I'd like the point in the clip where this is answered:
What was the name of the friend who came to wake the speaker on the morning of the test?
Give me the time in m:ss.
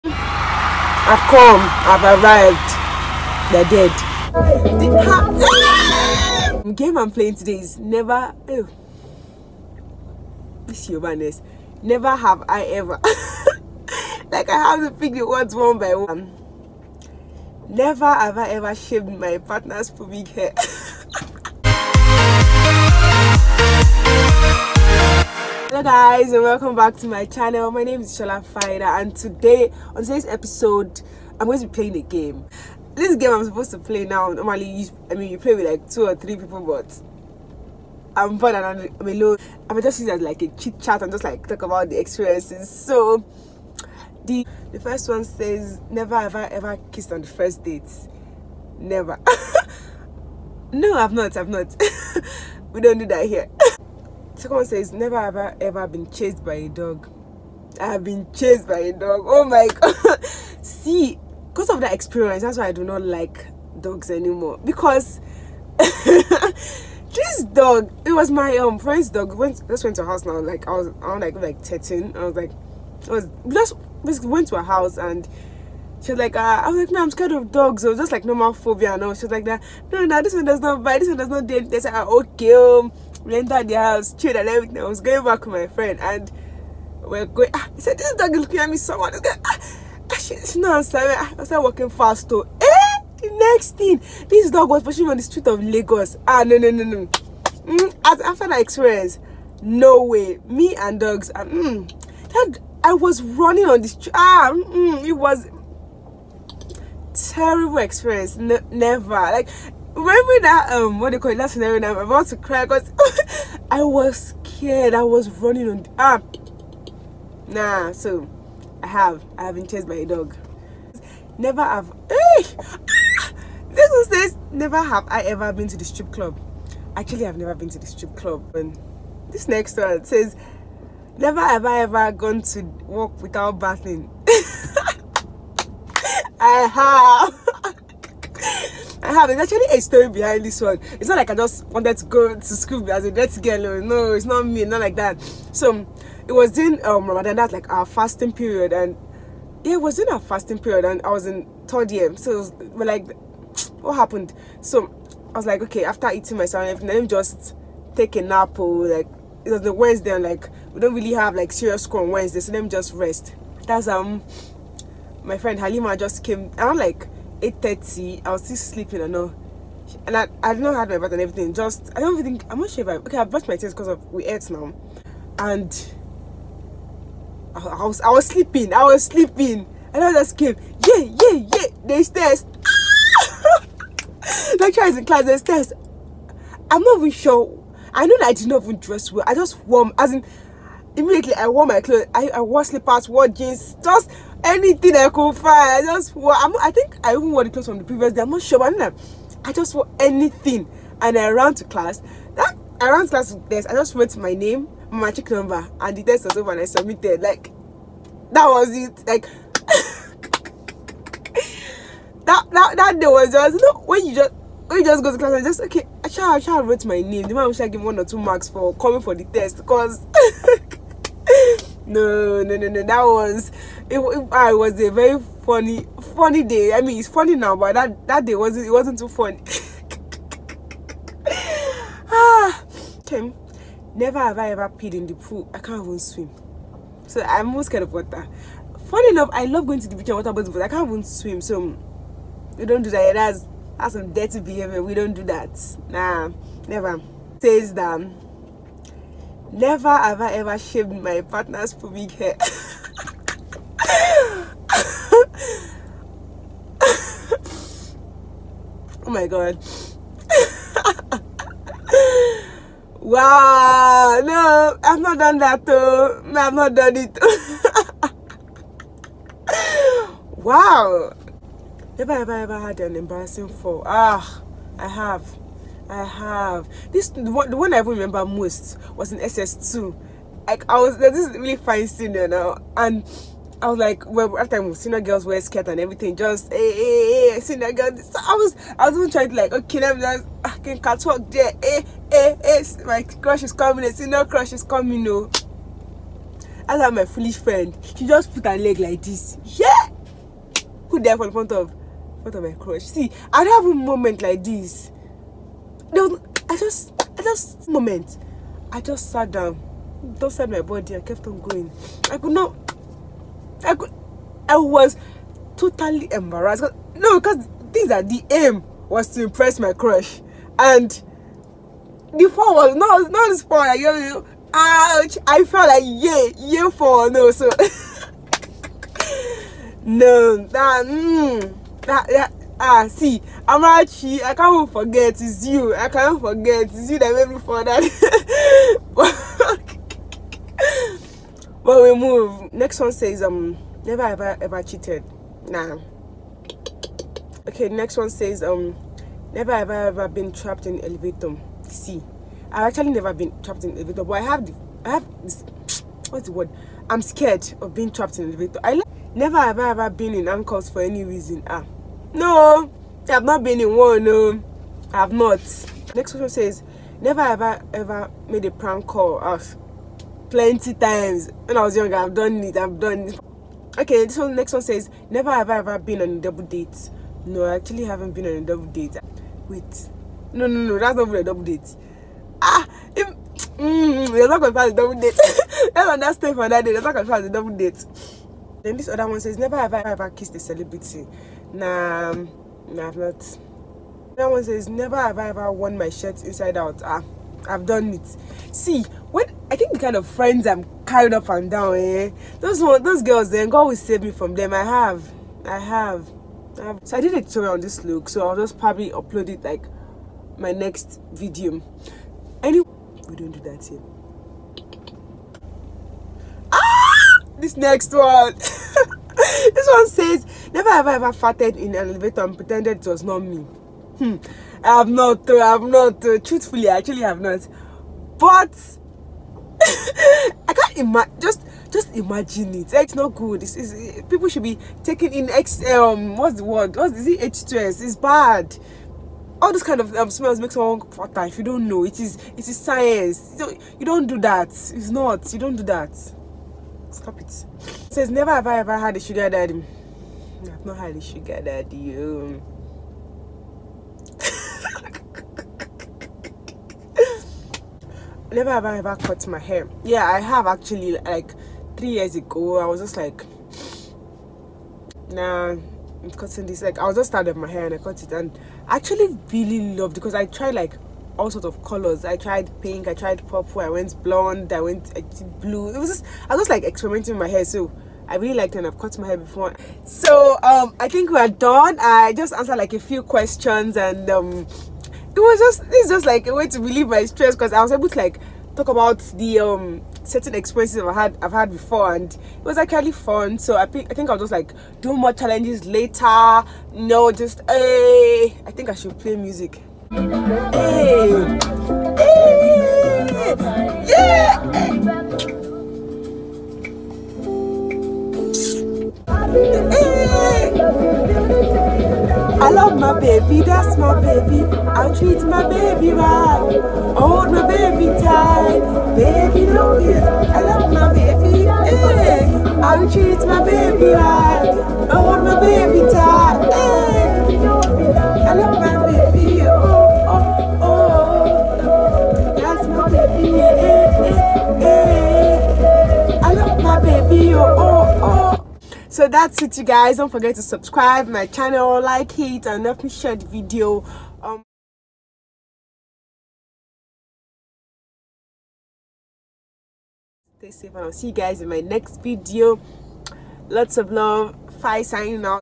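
2:45.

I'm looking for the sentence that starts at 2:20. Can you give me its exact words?
It's not like I just wanted to go to school as a dirty girl.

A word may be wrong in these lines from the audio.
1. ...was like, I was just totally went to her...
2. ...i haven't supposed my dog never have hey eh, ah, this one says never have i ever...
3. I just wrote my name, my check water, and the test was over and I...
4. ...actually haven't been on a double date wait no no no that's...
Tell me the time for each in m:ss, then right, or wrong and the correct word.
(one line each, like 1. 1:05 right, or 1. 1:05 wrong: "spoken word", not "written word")
1. 1:12 wrong: "basically", not "totally"
2. 1:59 wrong: "chased", not "supposed"
3. 3:23 wrong: "number", not "water"
4. 6:17 right.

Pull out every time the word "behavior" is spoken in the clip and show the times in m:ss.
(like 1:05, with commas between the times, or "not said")
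4:04.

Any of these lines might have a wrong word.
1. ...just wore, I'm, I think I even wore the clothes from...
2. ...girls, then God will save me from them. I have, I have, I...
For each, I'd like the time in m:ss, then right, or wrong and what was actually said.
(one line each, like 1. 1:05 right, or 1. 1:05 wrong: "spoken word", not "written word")
1. 3:15 right
2. 6:43 right.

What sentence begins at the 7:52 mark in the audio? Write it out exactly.
I tried pink, I tried purple, I went blonde, I went I blue.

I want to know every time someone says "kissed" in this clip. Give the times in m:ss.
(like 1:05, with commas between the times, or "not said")
0:46, 6:30.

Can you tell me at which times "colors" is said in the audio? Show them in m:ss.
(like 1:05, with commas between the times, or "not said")
7:51.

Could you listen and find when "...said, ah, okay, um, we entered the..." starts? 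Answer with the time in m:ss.
1:21.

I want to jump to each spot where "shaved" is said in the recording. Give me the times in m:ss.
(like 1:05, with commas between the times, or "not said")
0:18, 4:10.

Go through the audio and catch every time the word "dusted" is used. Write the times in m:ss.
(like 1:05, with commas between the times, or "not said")
5:10.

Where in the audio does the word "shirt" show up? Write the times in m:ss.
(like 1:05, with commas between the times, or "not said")
6:35.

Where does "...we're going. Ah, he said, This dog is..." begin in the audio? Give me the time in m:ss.
1:27.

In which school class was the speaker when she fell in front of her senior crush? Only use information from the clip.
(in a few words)
SS2.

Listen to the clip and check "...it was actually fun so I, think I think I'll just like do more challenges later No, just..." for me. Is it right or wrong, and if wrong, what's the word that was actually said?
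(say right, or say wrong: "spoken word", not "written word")
right.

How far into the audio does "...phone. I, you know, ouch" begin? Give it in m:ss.
5:23.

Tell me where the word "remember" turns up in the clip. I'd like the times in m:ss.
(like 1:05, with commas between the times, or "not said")
1:49, 4:37.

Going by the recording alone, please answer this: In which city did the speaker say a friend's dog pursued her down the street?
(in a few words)
Lagos.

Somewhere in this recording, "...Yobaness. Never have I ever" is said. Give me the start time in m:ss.
0:10.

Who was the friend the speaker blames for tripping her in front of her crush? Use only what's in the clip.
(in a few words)
Amarachi.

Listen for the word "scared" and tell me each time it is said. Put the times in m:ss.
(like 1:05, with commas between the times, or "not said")
1:17, 1:54, 3:57, 5:57.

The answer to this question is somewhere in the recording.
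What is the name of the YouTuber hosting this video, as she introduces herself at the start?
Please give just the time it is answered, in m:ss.
0:28.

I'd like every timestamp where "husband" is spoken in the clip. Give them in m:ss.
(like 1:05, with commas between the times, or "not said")
not said.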